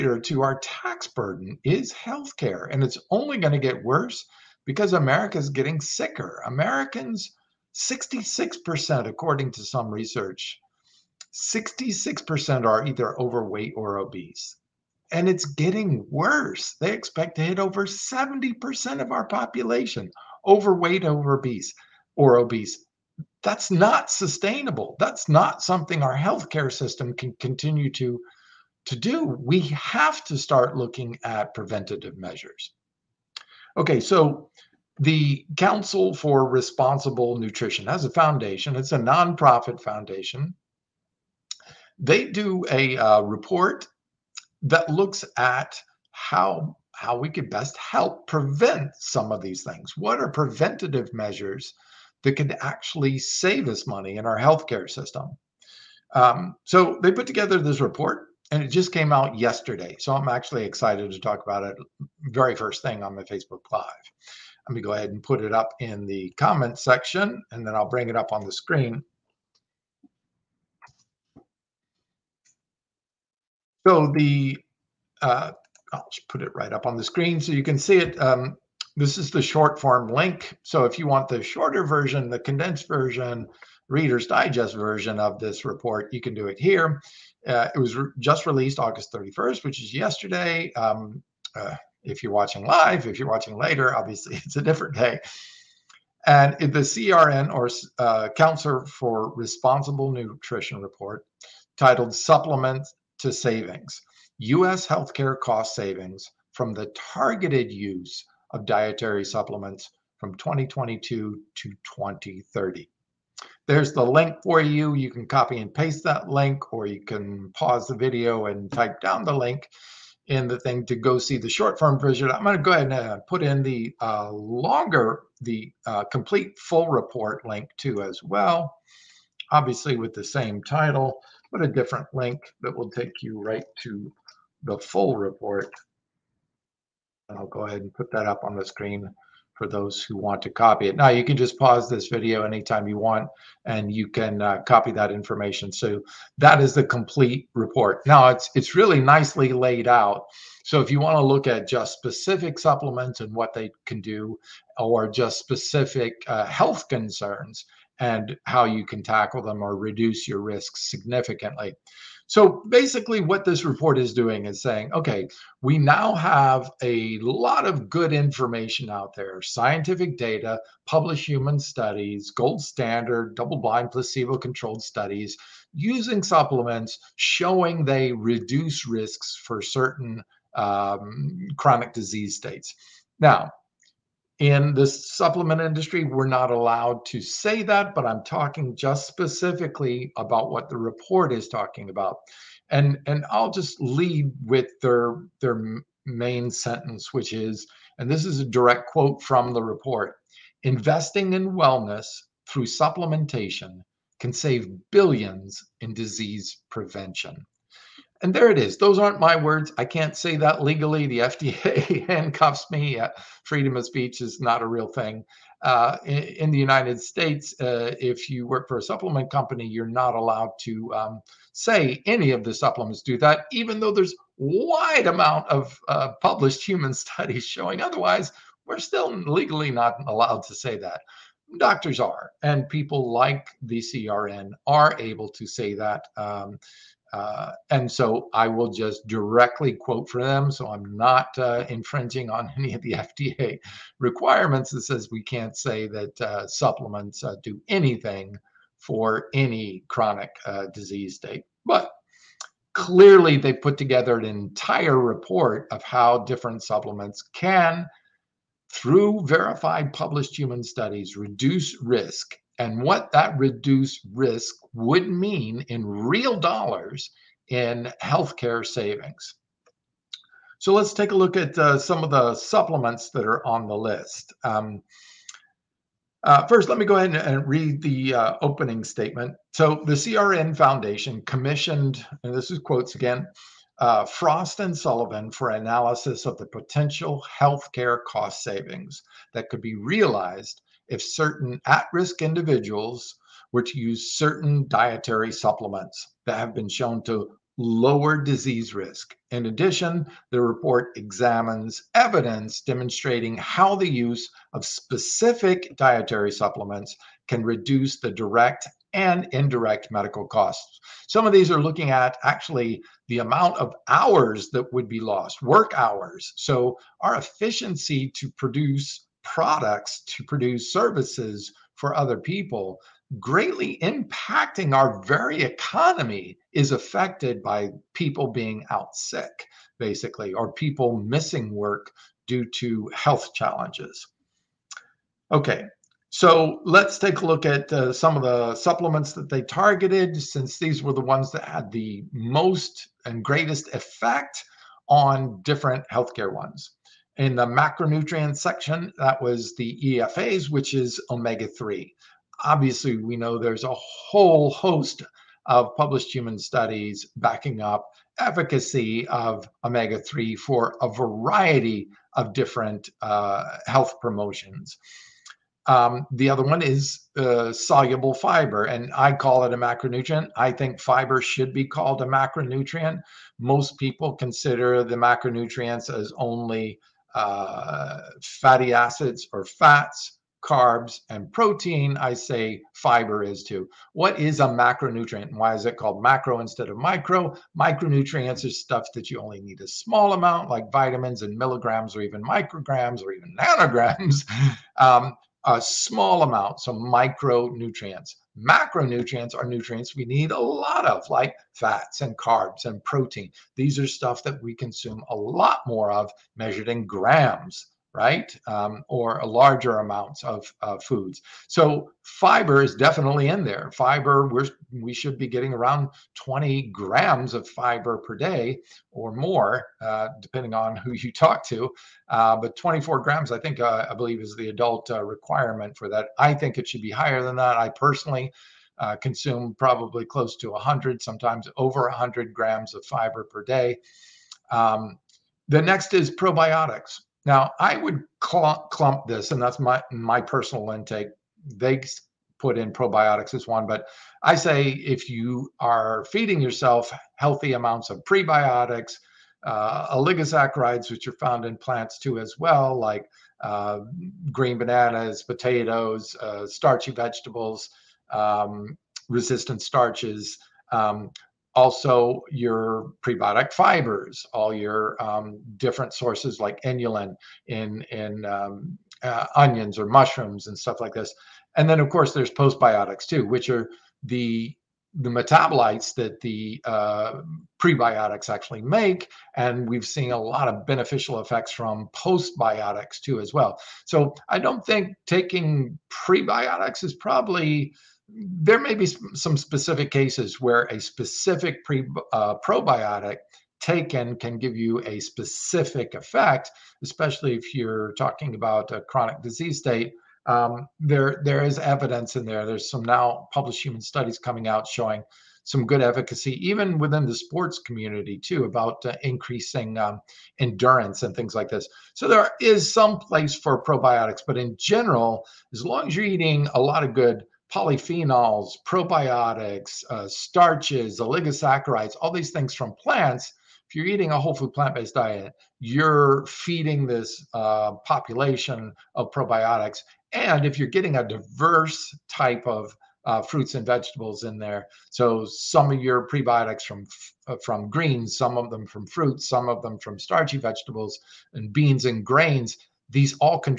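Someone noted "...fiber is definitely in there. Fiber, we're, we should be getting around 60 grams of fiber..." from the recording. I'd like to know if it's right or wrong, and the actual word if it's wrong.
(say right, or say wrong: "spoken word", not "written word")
wrong: "20", not "60".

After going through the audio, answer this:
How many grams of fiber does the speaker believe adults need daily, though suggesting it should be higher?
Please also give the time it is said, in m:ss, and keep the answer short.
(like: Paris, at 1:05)
24 grams, at 7:02.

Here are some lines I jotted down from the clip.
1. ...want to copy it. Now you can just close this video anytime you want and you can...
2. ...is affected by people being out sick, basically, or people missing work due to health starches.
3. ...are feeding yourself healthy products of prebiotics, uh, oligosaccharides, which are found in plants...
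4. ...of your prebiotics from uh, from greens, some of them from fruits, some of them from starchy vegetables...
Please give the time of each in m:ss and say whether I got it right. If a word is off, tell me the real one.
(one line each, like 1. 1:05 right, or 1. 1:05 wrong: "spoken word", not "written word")
1. 2:20 wrong: "pause", not "close"
2. 5:26 wrong: "challenges", not "starches"
3. 7:25 wrong: "amounts", not "products"
4. 8:55 right.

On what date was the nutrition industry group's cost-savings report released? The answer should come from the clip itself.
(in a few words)
August 31st.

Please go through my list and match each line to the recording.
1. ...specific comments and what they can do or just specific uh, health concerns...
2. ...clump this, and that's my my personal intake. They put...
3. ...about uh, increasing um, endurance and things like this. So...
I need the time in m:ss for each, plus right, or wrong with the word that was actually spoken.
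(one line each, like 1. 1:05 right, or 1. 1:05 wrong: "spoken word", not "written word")
1. 2:31 wrong: "supplements", not "comments"
2. 7:18 right
3. 8:28 right.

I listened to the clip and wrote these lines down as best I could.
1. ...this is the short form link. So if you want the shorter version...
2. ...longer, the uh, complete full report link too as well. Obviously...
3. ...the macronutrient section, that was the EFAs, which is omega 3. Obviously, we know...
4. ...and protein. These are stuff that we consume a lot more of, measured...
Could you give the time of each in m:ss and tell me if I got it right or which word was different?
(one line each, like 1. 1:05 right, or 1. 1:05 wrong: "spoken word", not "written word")
1. 1:18 right
2. 2:04 right
3. 5:47 right
4. 6:42 right.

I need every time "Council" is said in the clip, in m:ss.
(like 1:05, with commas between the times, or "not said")
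0:35, 1:38.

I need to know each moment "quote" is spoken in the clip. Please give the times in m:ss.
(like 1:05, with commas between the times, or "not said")
3:18, 3:59, 4:42.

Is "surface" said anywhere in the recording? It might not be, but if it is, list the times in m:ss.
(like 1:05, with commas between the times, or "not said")
not said.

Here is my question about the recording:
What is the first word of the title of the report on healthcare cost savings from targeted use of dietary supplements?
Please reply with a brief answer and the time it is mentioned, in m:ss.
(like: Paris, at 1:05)
Supplement to Savings, at 1:42.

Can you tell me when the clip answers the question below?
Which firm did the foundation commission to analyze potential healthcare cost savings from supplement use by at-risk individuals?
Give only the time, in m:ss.
4:44.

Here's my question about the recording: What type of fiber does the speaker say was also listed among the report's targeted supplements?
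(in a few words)
soluble fiber.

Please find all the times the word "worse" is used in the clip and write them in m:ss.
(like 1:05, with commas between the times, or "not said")
0:03, 0:16.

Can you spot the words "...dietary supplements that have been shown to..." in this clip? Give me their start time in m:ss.
4:54.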